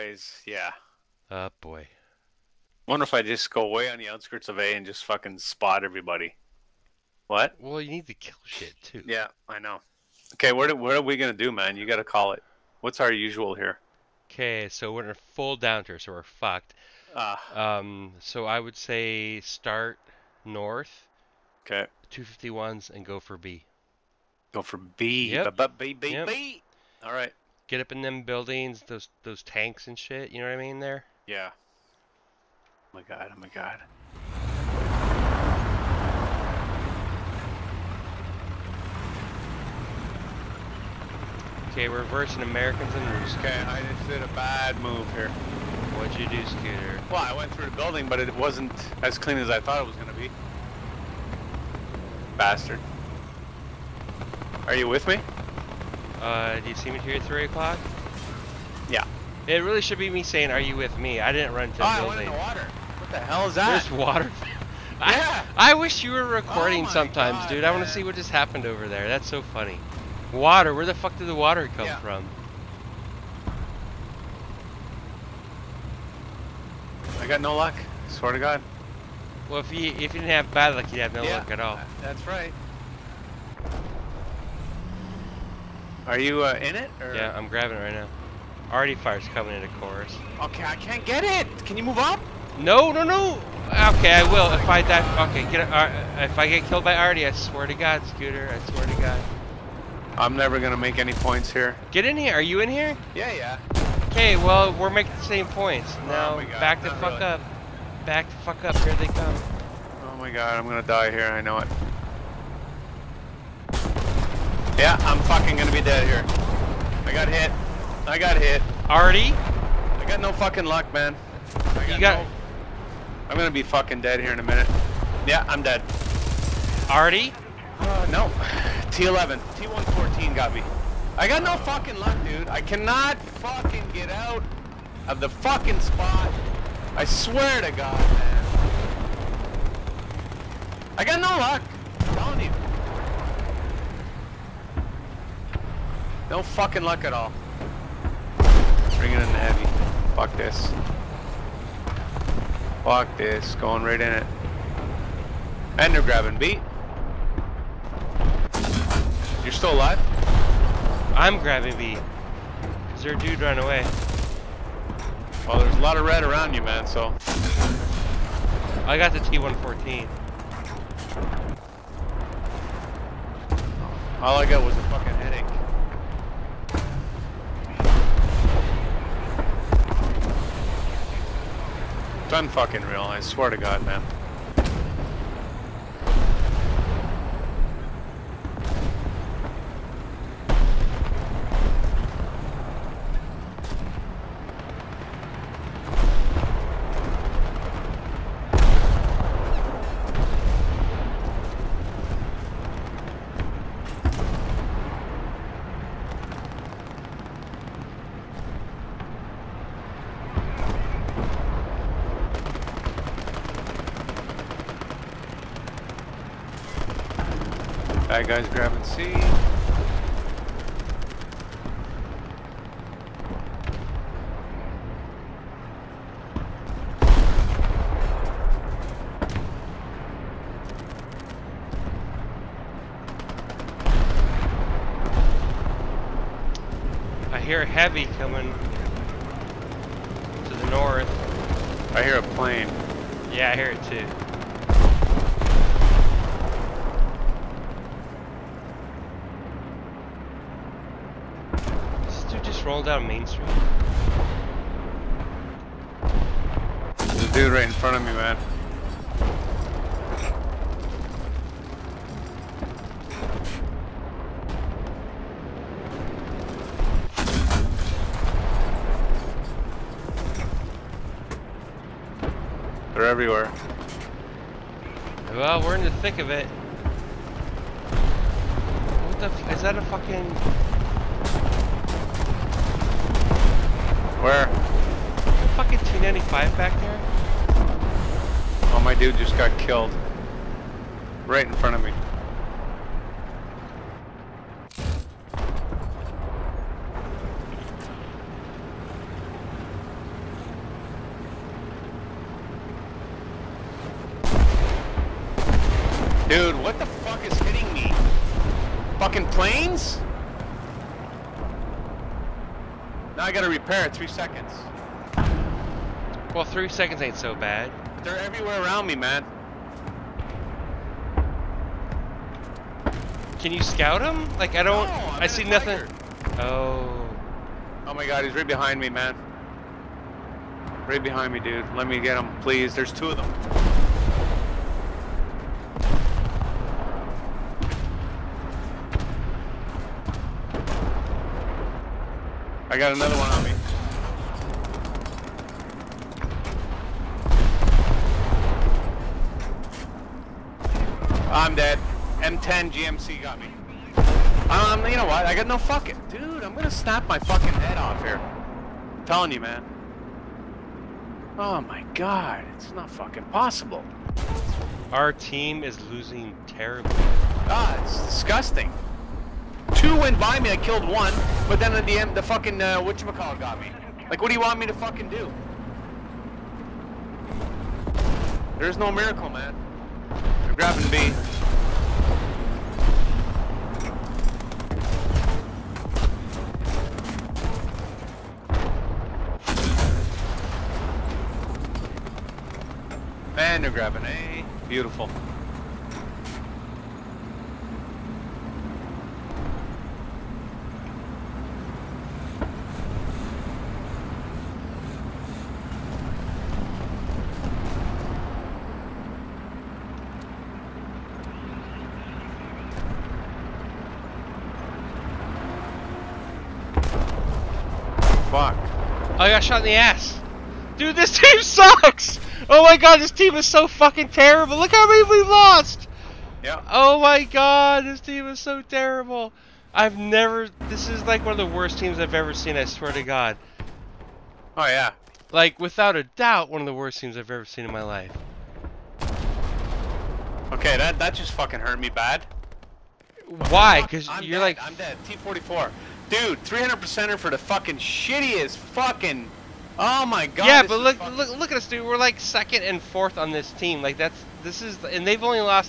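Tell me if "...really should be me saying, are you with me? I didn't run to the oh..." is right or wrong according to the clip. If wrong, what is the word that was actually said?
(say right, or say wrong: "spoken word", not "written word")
right.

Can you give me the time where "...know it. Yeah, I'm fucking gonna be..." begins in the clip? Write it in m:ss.
1:51.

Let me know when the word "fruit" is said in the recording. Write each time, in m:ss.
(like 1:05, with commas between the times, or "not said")
not said.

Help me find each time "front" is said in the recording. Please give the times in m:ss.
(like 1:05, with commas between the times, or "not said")
4:17, 4:51.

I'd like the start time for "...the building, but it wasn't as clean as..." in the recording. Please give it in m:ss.
0:47.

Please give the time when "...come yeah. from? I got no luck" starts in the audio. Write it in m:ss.
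1:11.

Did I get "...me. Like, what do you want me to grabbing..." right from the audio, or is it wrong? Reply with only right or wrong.
wrong.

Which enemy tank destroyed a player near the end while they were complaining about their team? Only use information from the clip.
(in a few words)
T-44.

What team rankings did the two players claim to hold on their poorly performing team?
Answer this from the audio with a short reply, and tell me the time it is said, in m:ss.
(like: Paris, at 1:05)
Second and fourth, at 7:32.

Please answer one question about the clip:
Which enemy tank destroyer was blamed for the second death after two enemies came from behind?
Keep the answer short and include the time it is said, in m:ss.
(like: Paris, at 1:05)
M10 GMC, at 5:52.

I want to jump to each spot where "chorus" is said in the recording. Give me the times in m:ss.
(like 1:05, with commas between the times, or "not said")
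1:29.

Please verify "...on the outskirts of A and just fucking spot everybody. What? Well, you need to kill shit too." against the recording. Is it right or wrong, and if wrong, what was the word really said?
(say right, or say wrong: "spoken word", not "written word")
right.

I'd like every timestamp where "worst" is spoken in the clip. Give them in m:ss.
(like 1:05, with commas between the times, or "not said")
7:11, 7:16.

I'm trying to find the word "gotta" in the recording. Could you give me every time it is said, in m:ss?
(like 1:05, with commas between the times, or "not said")
0:11, 5:13.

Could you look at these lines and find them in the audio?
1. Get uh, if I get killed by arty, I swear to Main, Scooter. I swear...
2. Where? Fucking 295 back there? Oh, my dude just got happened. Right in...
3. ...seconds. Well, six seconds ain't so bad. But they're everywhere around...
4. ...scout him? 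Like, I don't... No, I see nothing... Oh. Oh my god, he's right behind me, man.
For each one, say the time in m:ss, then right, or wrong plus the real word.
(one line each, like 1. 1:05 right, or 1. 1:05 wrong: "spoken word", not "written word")
1. 1:35 wrong: "God", not "Main"
2. 4:44 wrong: "killed", not "happened"
3. 5:14 wrong: "three", not "six"
4. 5:23 right.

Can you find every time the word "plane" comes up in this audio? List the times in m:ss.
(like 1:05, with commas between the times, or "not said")
4:02, 5:09.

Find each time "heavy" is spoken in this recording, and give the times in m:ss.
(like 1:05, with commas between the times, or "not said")
2:29, 3:57.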